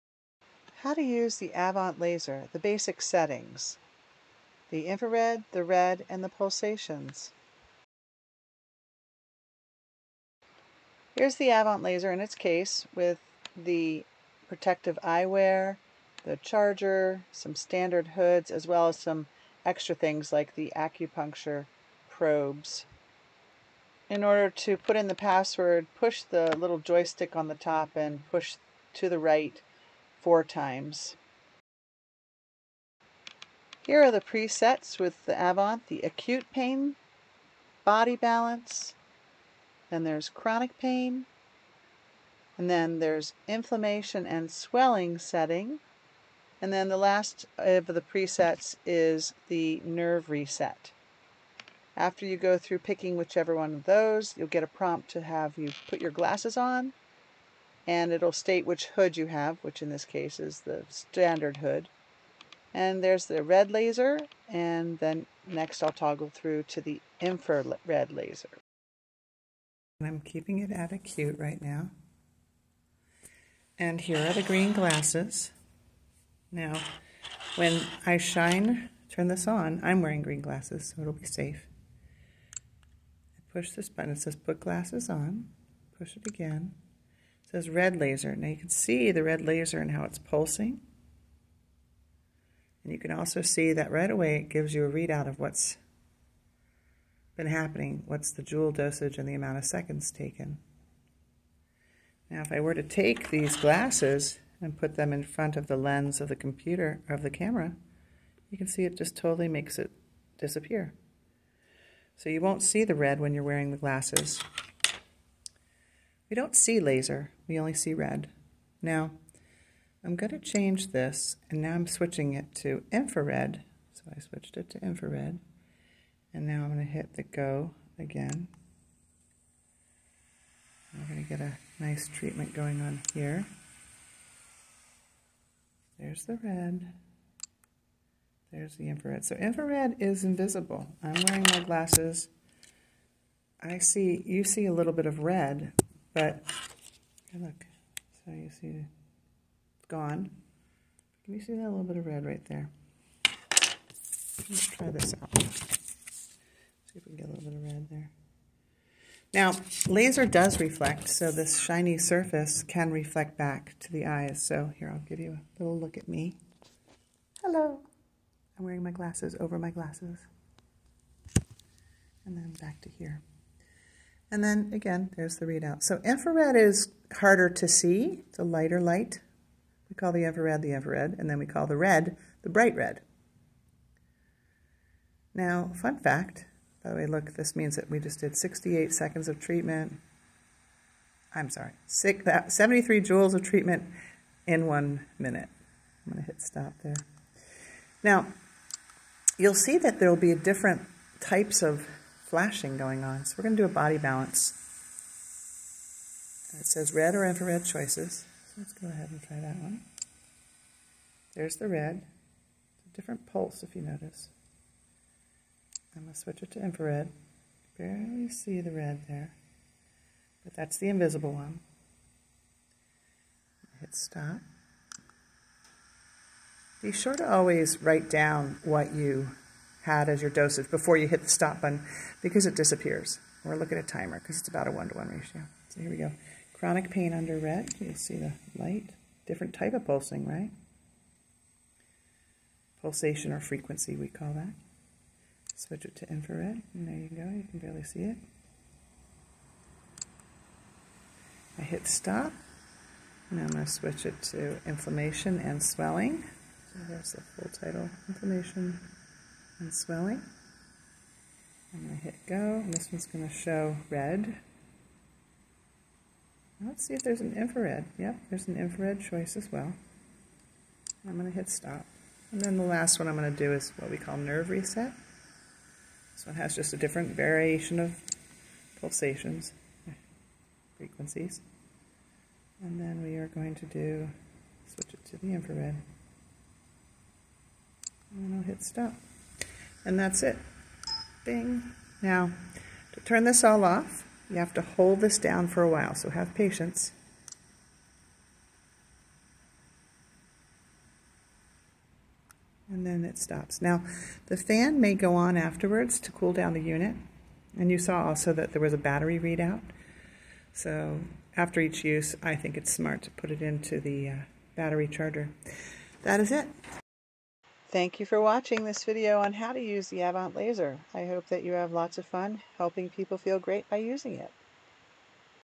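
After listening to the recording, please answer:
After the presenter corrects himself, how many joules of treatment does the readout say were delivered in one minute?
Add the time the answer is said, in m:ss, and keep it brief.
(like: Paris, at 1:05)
73, at 3:11.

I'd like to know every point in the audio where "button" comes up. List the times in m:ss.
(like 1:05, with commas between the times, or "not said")
1:23, 3:51.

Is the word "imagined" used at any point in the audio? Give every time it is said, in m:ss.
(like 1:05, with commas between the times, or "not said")
not said.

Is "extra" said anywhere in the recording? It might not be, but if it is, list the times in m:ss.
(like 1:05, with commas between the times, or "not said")
0:19.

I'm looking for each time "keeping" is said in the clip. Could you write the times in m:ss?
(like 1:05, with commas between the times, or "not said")
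1:10.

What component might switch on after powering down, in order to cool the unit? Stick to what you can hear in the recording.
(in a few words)
The fan.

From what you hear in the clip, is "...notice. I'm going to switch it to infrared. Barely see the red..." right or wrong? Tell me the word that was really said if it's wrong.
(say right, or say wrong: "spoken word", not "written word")
right.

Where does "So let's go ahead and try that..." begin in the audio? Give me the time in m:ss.
3:28.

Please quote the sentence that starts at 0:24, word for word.
In order to put in the password, push the little joystick on the top and push to the right four times.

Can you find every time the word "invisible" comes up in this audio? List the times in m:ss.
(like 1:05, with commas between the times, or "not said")
2:20, 3:40.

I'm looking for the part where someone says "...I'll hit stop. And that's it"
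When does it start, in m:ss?
4:48.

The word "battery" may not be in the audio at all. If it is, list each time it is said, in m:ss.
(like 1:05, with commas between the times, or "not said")
5:08, 5:14.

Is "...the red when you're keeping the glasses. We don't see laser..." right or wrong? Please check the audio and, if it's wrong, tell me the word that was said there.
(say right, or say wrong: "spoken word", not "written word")
wrong: "wearing", not "keeping".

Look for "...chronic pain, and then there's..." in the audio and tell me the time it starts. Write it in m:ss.
0:40.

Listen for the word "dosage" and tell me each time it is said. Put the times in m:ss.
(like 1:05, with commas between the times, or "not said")
1:38, 3:50.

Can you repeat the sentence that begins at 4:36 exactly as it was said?
This one has just a different variation of pulsations, frequencies.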